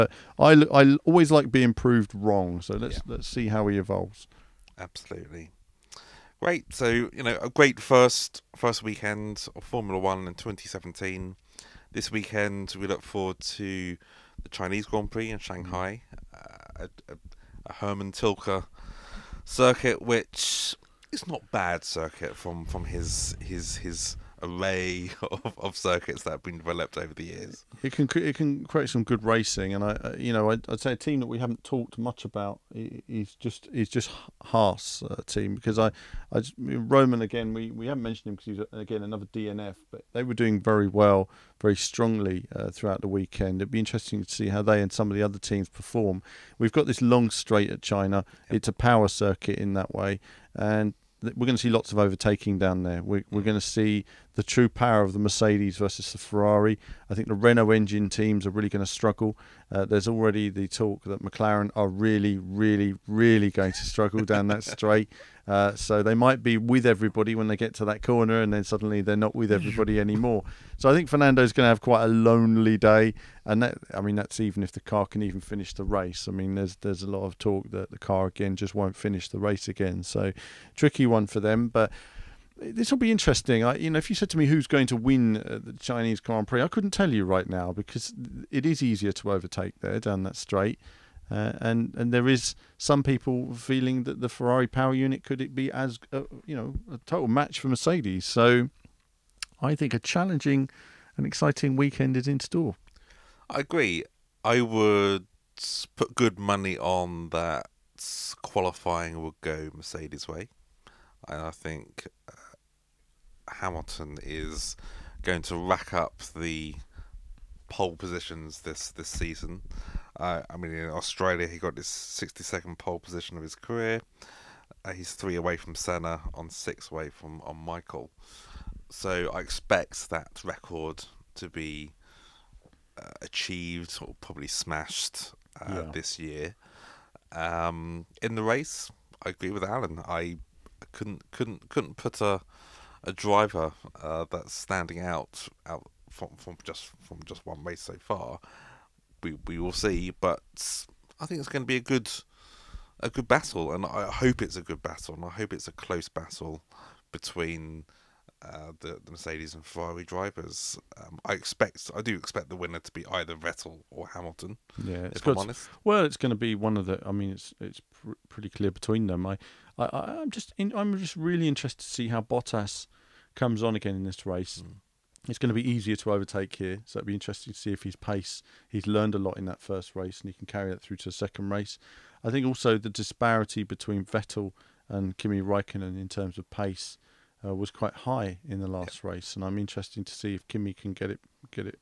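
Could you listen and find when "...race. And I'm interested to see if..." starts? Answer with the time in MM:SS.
03:09.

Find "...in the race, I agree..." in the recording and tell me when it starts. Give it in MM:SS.
02:18.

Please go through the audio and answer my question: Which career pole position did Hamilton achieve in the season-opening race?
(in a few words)
62nd.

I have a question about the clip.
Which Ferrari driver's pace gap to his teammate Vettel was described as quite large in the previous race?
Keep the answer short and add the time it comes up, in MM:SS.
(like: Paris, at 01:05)
Kimi Raikkonen, at 03:05.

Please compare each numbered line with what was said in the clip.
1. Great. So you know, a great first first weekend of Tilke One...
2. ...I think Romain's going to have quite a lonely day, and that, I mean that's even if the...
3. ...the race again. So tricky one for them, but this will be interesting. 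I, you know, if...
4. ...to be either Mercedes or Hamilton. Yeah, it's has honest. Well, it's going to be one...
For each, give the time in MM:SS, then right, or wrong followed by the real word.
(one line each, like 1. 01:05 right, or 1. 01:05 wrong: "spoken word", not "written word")
1. 00:06 wrong: "Formula", not "Tilke"
2. 01:10 wrong: "Fernando", not "Romain"
3. 01:19 right
4. 02:42 wrong: "Vettel", not "Mercedes".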